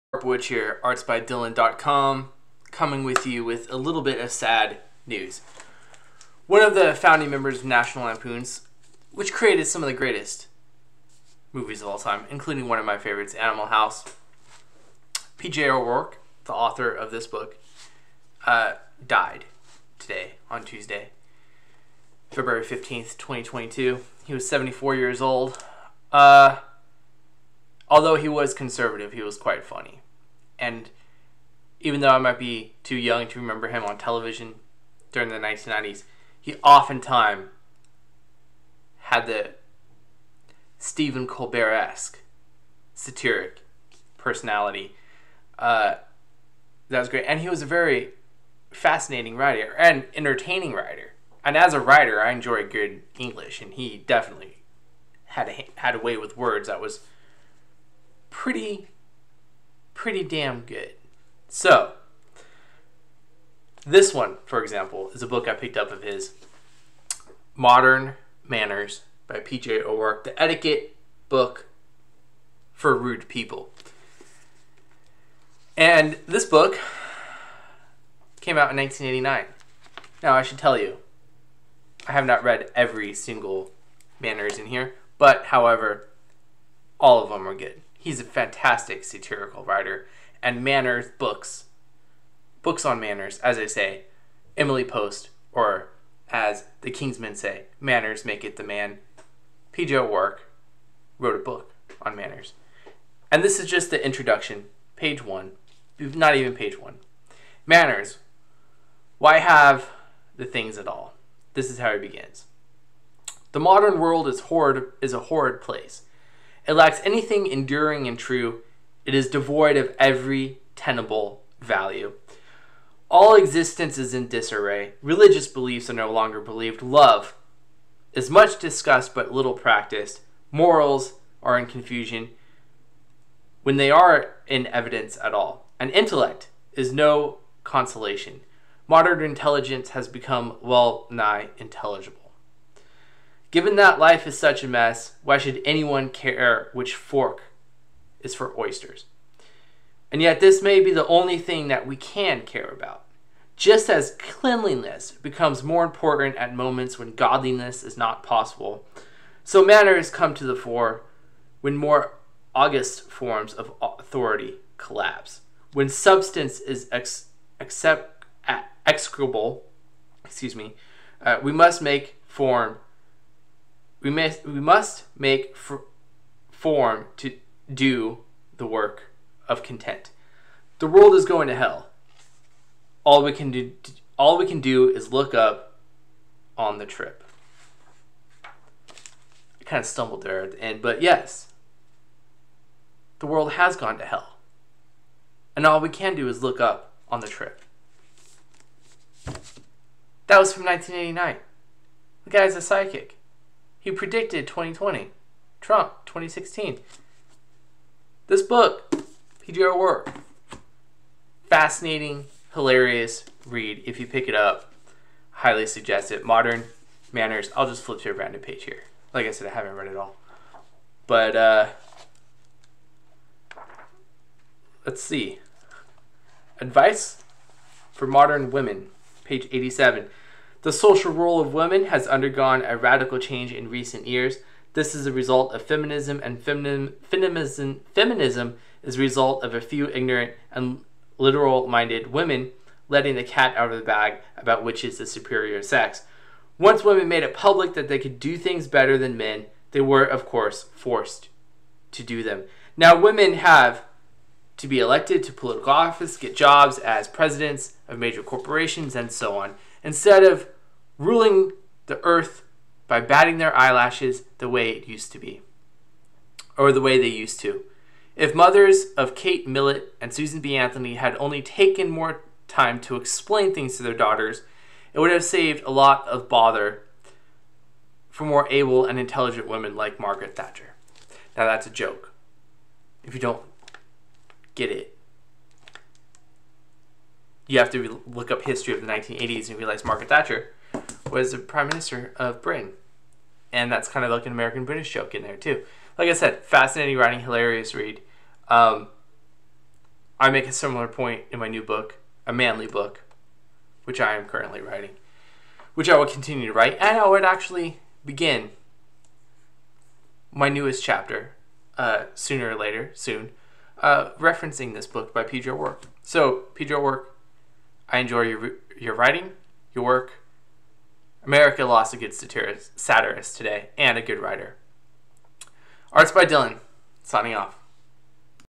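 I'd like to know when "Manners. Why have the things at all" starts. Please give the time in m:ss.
1:47.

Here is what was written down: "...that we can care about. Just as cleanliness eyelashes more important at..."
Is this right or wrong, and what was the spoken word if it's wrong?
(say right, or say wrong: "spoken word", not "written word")
wrong: "becomes", not "eyelashes".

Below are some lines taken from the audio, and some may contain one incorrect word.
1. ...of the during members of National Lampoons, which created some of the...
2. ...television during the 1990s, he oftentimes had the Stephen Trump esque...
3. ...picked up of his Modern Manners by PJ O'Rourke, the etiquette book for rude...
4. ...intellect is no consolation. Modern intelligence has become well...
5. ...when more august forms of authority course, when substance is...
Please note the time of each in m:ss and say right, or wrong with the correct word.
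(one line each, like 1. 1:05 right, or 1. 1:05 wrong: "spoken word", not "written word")
1. 0:06 wrong: "founding", not "during"
2. 0:33 wrong: "Colbert", not "Trump"
3. 1:05 right
4. 2:15 right
5. 2:41 wrong: "collapse", not "course".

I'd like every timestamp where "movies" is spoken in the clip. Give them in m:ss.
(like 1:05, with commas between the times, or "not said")
0:11.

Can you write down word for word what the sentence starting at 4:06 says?
Once women made it public that they could do things better than men, they were, of course, forced to do them.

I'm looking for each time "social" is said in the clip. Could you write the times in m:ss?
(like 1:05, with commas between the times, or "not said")
3:50.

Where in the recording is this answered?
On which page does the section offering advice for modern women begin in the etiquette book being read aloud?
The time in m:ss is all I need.
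3:49.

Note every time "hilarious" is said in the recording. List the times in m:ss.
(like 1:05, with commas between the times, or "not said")
3:32, 4:57.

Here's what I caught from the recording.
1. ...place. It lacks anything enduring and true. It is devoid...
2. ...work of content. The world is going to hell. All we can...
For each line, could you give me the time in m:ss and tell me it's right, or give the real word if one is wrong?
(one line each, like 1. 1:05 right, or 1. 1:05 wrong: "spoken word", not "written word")
1. 1:55 right
2. 2:58 right.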